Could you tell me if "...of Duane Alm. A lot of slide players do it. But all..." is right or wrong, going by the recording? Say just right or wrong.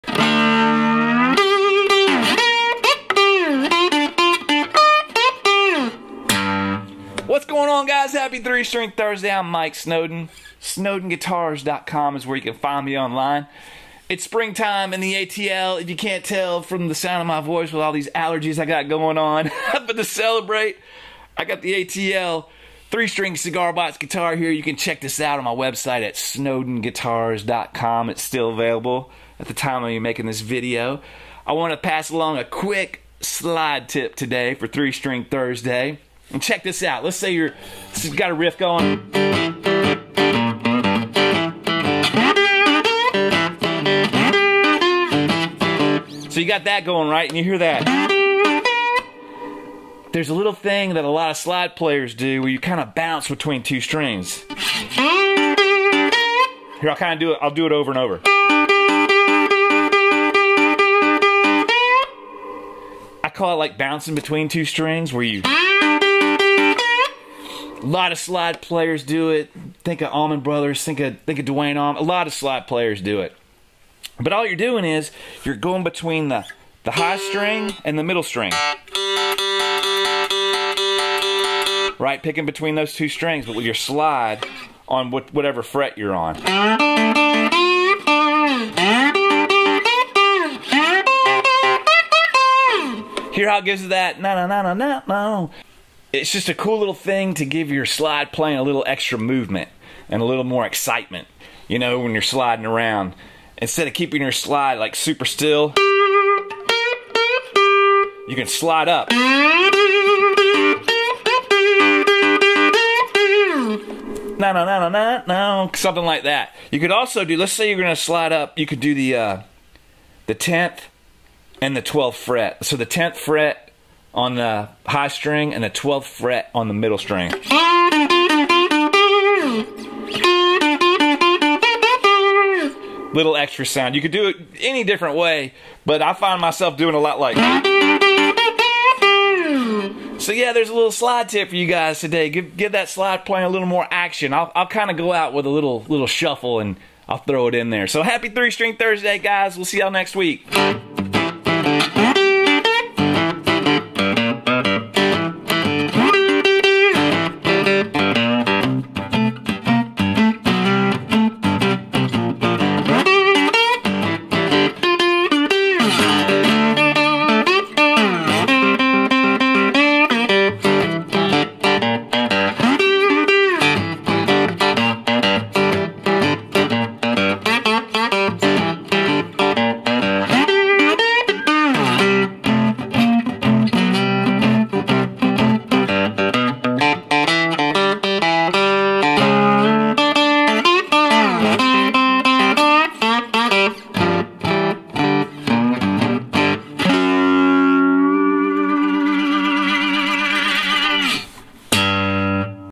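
right.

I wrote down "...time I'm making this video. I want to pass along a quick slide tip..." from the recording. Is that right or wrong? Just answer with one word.
right.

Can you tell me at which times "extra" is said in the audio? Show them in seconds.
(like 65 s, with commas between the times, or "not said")
98 s, 133 s.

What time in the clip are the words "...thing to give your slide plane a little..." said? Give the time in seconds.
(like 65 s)
96 s.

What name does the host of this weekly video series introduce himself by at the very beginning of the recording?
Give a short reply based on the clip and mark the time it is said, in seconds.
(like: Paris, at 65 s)
Mike Snowden, at 9 s.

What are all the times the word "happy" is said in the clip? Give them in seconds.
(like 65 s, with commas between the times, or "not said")
8 s, 148 s.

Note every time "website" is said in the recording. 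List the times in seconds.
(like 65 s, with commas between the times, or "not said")
25 s.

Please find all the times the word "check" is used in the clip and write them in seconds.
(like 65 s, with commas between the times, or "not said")
24 s, 36 s.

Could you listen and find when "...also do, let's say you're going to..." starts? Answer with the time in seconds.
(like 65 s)
116 s.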